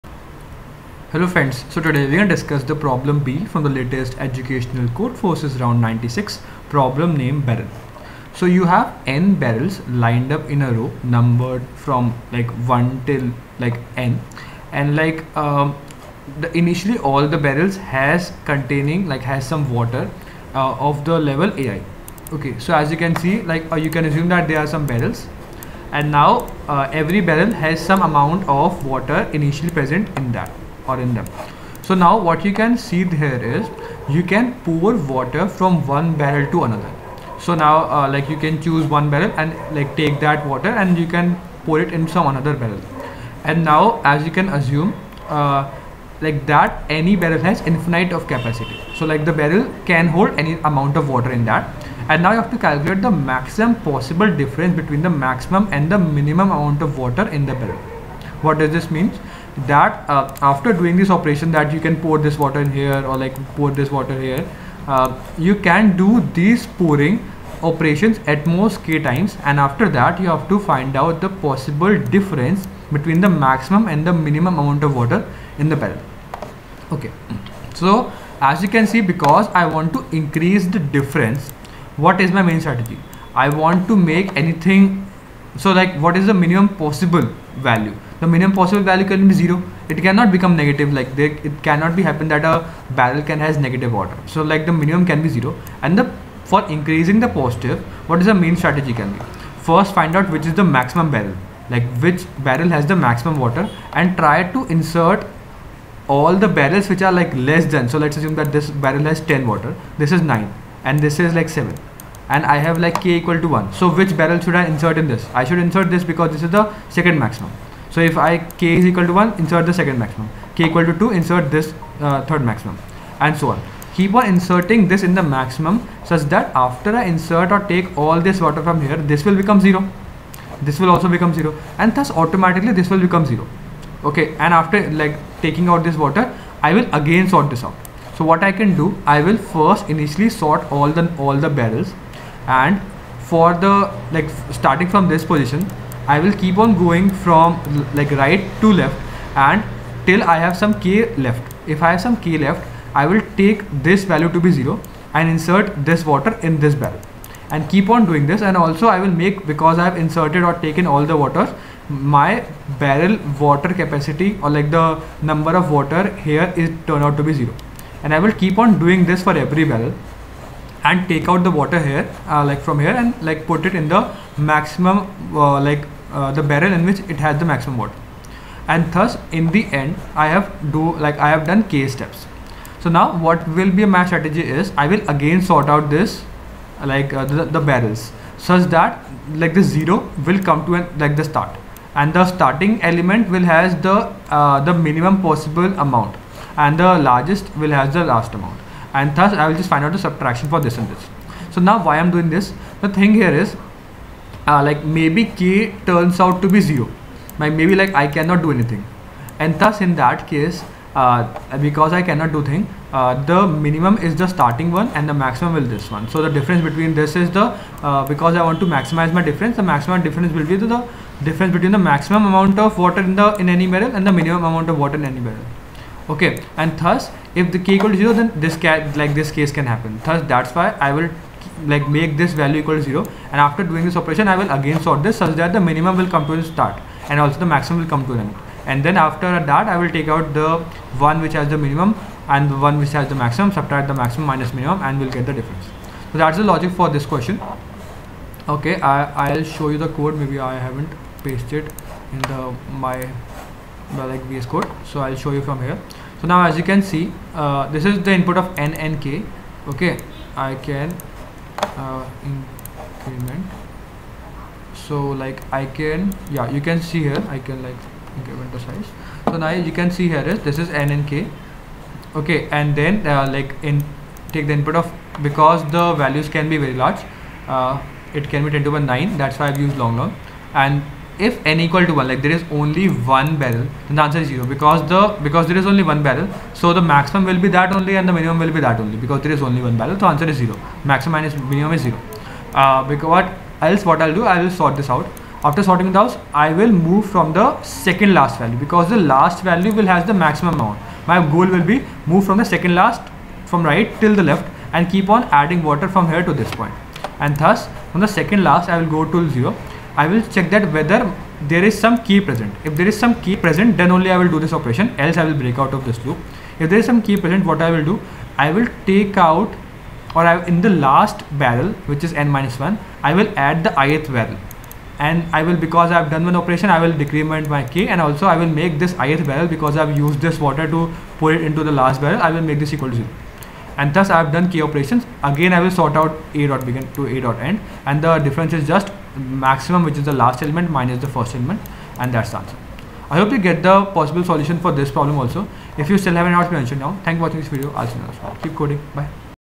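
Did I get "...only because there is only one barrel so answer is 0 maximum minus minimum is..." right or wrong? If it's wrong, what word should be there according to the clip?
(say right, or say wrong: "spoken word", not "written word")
right.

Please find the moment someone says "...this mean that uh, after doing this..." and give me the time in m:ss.
0:58.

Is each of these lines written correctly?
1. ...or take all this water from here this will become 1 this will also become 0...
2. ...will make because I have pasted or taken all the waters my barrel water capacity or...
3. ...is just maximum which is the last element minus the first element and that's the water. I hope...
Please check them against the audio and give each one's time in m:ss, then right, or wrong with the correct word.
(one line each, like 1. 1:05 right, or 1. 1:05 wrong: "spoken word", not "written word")
1. 2:07 wrong: "0", not "1"
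2. 2:38 wrong: "inserted", not "pasted"
3. 5:38 wrong: "answer", not "water".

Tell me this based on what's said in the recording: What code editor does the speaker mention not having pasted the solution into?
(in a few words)
VS Code.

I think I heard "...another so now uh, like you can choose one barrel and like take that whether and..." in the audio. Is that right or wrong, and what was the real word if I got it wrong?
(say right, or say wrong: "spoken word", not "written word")
wrong: "water", not "whether".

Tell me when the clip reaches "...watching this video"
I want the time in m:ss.
5:47.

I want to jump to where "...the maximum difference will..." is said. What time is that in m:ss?
3:39.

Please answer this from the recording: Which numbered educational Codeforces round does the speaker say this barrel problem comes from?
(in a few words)
96.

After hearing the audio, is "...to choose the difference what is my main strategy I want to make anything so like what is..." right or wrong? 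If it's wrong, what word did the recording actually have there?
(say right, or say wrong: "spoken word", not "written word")
wrong: "increase", not "choose".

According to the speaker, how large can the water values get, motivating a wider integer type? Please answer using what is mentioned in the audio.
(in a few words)
10 to the 9.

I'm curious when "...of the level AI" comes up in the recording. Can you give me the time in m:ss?
0:20.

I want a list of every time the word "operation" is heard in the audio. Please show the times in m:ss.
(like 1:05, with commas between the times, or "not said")
1:01, 1:07, 3:53, 5:14, 5:26, 5:34.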